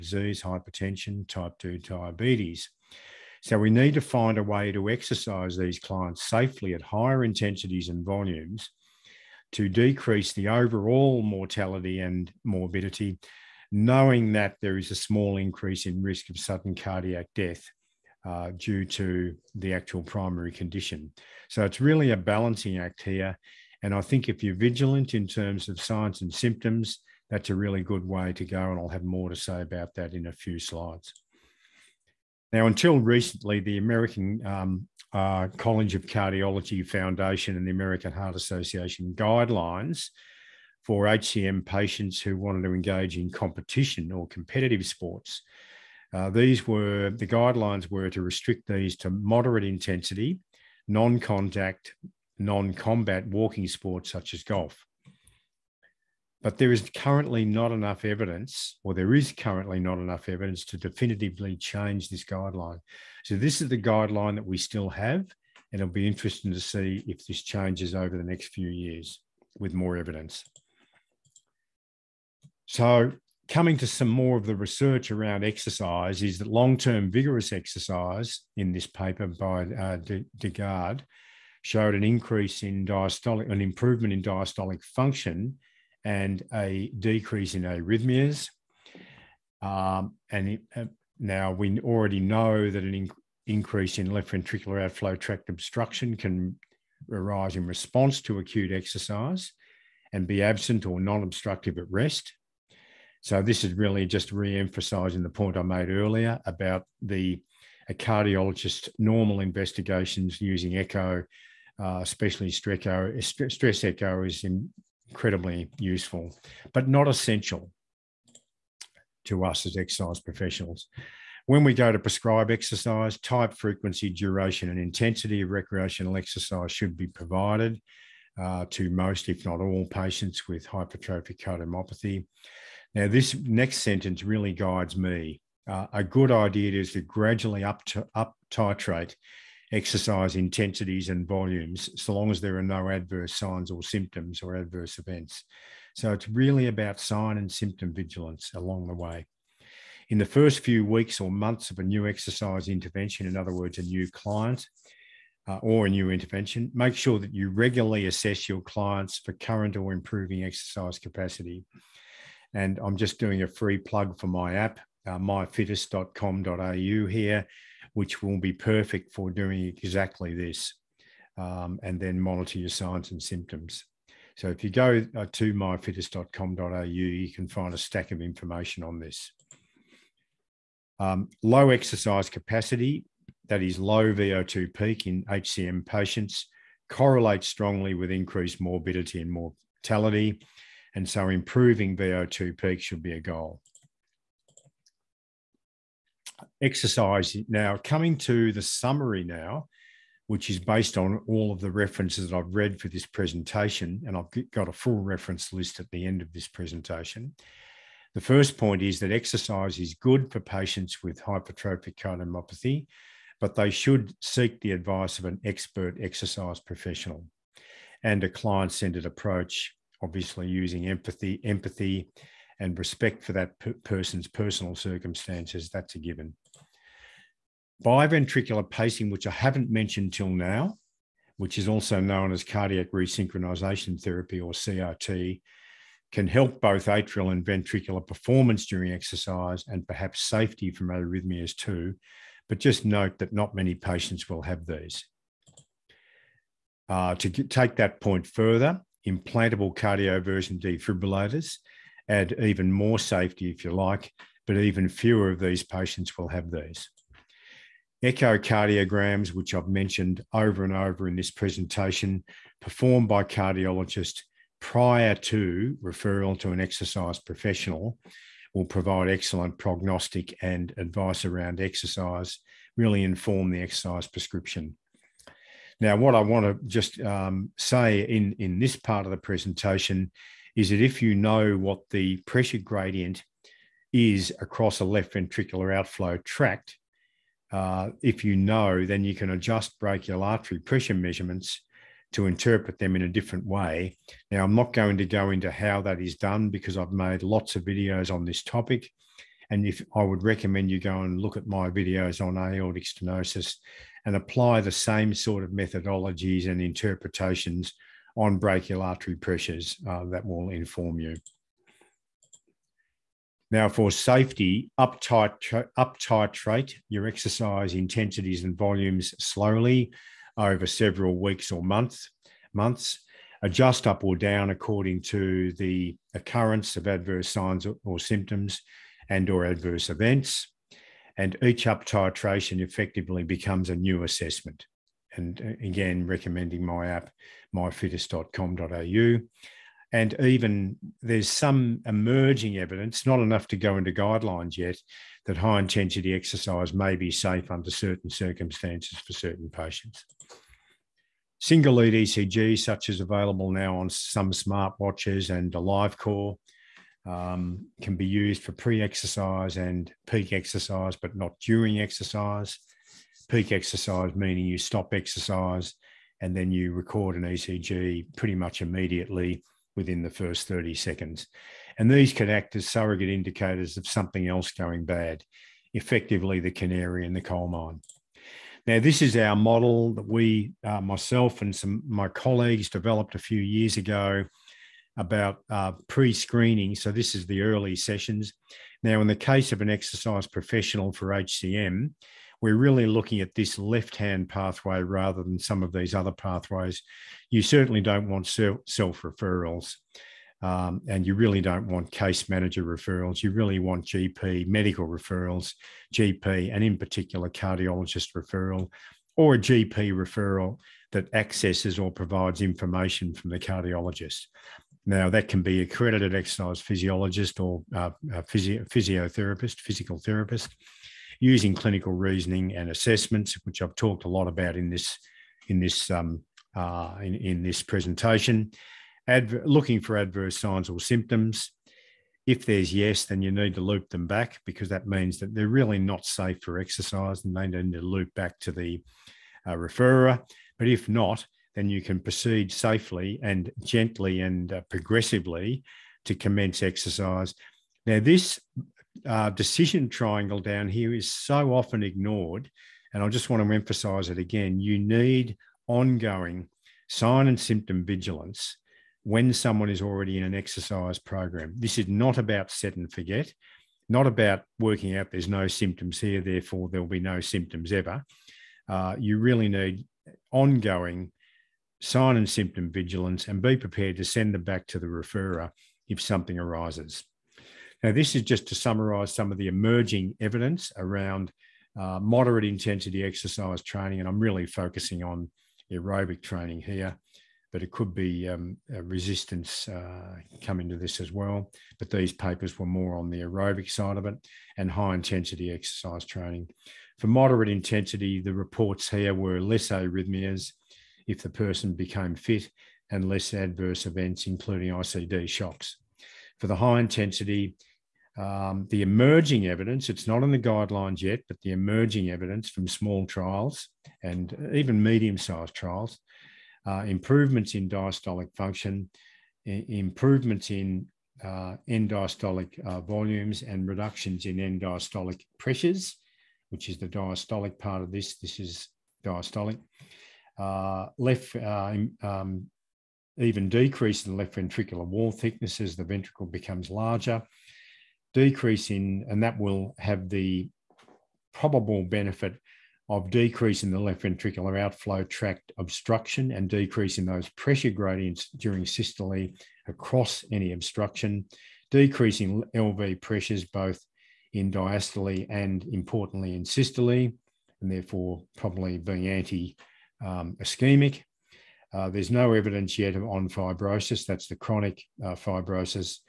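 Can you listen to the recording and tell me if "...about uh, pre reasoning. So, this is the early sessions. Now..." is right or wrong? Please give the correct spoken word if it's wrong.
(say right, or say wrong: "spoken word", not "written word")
wrong: "screening", not "reasoning".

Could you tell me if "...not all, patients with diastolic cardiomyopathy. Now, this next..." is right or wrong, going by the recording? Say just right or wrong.
wrong.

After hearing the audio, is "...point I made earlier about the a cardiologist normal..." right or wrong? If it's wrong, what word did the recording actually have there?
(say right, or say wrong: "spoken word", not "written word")
right.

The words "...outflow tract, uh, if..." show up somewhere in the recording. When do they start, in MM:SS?
04:45.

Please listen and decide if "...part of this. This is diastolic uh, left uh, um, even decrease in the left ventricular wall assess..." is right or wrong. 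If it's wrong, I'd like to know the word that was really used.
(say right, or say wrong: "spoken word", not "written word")
wrong: "thickness", not "assess".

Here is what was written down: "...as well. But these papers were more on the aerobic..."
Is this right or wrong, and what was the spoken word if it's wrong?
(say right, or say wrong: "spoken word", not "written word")
right.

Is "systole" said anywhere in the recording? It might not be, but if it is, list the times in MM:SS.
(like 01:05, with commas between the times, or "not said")
09:08, 09:16.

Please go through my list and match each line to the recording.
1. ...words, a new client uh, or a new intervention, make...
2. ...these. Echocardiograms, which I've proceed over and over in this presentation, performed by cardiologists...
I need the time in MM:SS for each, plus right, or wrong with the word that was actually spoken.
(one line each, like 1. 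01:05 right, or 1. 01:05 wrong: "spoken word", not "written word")
1. 02:33 right
2. 04:16 wrong: "mentioned", not "proceed".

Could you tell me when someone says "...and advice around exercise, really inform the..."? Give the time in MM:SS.
04:30.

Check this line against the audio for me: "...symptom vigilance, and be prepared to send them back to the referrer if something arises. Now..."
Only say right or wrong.
right.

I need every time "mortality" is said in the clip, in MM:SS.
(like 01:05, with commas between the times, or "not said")
00:11, 03:09.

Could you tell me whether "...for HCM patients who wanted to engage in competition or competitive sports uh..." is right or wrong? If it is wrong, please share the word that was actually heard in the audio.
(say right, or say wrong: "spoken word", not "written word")
right.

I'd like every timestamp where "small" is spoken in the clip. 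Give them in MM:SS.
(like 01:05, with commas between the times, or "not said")
00:14, 08:32.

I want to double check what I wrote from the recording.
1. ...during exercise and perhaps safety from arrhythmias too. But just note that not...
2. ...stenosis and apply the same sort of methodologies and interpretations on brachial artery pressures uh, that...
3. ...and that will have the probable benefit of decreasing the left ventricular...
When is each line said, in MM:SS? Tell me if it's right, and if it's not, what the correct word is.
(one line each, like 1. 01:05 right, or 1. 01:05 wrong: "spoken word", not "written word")
1. 03:58 right
2. 05:02 right
3. 08:59 right.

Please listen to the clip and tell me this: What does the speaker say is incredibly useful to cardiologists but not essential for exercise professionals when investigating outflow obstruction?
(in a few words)
stress echo.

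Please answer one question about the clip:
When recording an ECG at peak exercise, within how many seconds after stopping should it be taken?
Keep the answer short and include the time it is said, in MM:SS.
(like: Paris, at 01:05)
30, at 06:10.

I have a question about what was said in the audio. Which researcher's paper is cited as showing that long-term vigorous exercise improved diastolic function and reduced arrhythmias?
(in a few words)
Dejgaard.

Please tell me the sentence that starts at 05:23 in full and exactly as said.
Adjust up or down according to the occurrence of adverse signs or symptoms and or adverse events.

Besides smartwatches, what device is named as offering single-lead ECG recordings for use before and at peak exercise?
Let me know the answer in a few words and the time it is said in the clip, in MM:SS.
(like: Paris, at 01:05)
AliveCor, at 05:55.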